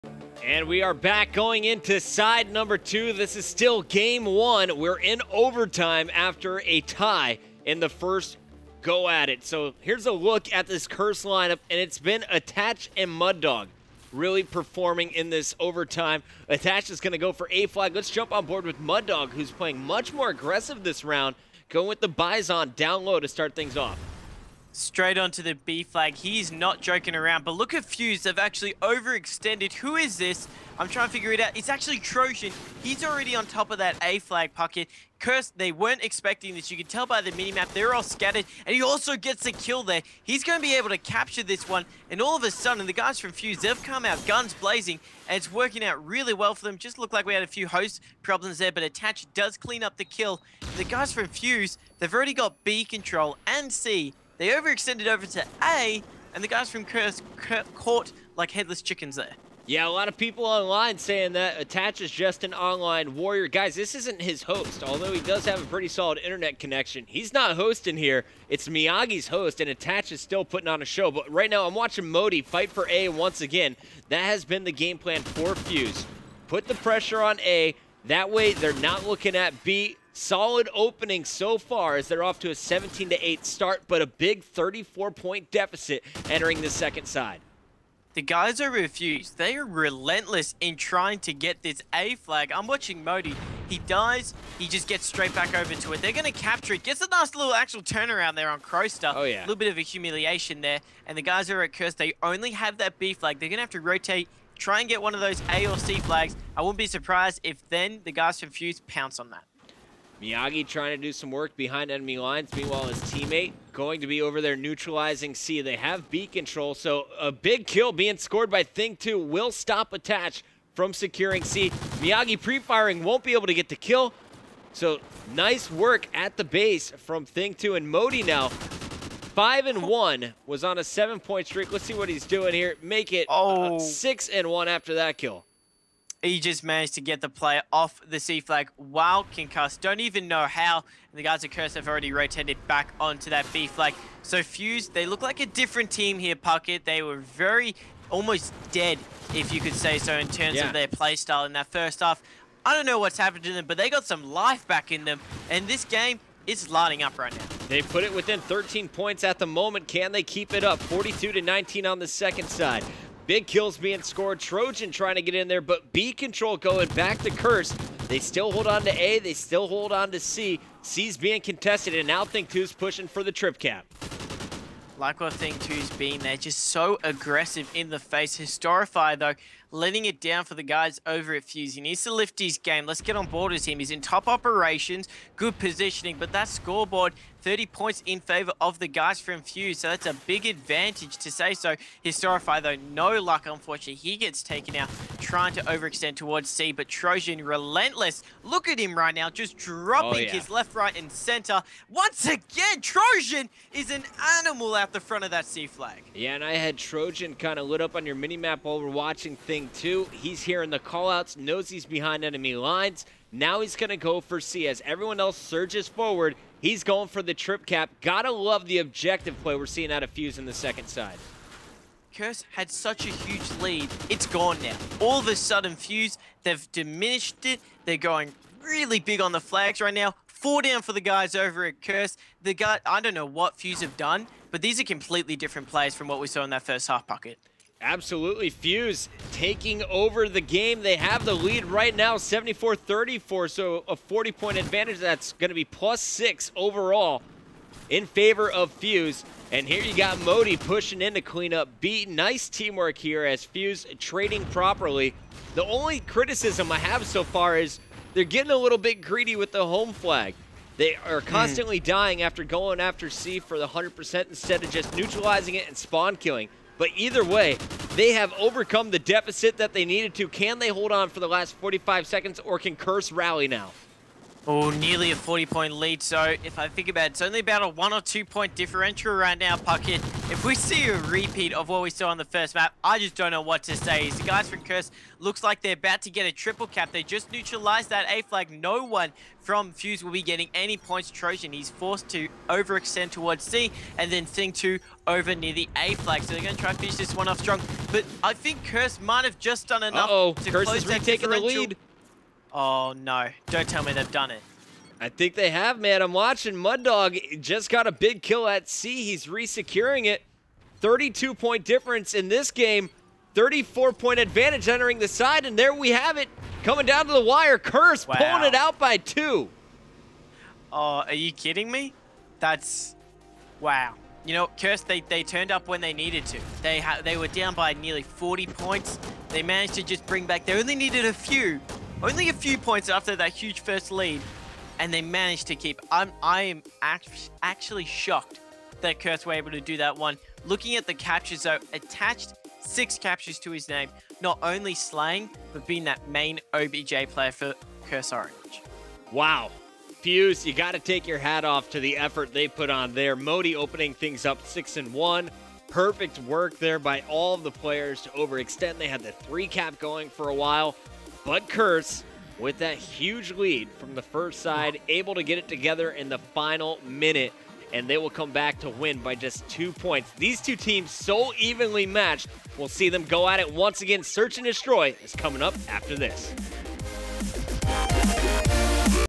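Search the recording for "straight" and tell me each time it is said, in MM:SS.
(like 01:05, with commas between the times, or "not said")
00:24, 01:35.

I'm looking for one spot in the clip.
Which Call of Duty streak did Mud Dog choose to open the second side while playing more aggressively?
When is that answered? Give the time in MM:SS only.
00:22.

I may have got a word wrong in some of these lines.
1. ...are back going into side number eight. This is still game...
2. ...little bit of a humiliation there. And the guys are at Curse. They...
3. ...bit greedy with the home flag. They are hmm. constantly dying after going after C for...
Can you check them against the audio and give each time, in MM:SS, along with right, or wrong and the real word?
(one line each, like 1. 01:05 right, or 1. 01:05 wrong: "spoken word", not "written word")
1. 00:00 wrong: "two", not "eight"
2. 01:39 right
3. 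04:18 right.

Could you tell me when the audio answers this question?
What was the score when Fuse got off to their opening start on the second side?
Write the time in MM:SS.
01:22.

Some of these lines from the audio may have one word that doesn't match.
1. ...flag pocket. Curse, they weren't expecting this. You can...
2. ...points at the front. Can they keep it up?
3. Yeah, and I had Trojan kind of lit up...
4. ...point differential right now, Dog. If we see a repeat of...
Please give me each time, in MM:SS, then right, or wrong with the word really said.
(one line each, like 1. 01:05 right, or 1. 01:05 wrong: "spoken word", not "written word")
1. 00:34 right
2. 02:38 wrong: "moment", not "front"
3. 03:26 right
4. 04:38 wrong: "Puckett", not "Dog".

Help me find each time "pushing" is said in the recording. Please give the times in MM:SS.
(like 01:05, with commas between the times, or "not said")
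02:52, 04:10.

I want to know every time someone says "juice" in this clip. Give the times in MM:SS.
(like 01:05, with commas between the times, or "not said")
not said.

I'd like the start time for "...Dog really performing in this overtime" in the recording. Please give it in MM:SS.
00:13.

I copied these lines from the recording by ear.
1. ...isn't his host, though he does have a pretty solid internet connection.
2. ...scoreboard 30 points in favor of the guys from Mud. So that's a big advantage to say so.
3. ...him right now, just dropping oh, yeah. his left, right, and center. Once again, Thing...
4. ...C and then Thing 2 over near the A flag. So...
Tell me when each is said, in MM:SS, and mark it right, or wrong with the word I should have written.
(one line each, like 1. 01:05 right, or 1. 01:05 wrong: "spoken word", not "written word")
1. 01:03 wrong: "although", not "though"
2. 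03:06 wrong: "Fuse", not "Mud"
3. 03:18 wrong: "Trojan", not "Thing"
4. 04:53 right.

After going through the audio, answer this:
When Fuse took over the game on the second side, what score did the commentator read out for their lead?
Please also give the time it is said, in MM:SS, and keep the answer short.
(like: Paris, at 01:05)
74-34, at 04:02.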